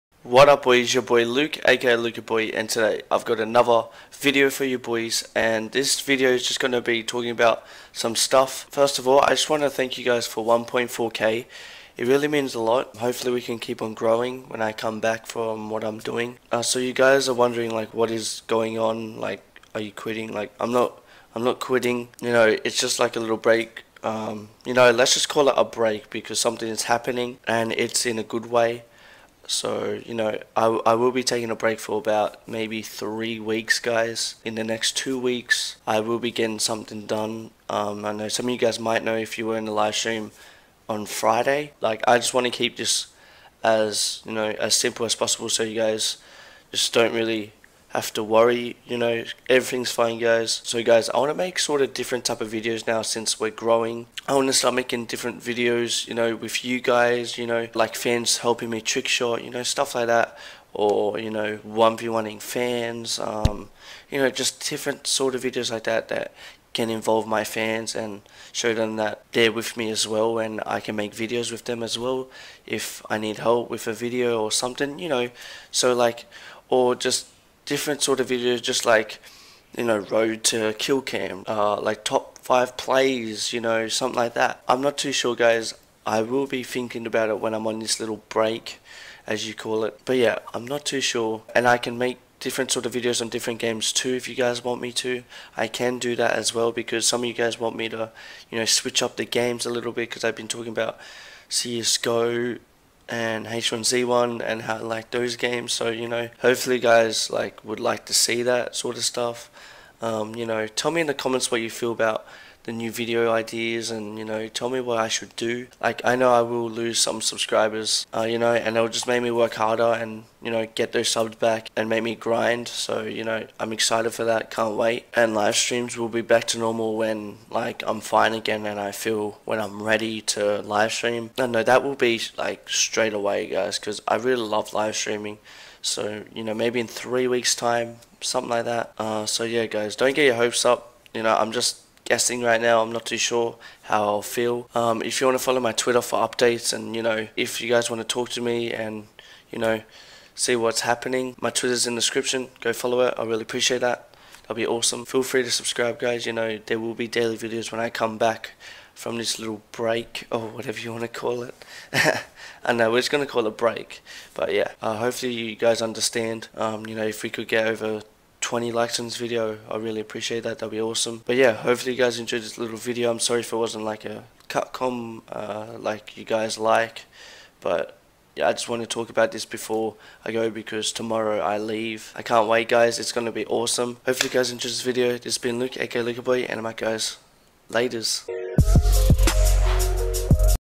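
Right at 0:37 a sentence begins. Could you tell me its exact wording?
Um, I know some of you guys might know if you were in the live stream on Friday.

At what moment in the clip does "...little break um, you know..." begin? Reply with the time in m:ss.
0:23.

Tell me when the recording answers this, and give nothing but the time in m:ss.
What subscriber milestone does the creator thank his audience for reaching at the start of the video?
0:10.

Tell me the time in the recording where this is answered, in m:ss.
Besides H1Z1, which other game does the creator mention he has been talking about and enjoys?
1:41.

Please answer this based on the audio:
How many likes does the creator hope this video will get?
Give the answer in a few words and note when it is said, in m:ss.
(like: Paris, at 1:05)
20, at 2:48.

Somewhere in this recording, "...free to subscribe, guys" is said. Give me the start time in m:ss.
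2:35.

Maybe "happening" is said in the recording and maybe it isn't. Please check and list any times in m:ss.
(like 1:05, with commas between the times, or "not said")
0:26, 2:30.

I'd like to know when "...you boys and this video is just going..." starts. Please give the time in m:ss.
0:04.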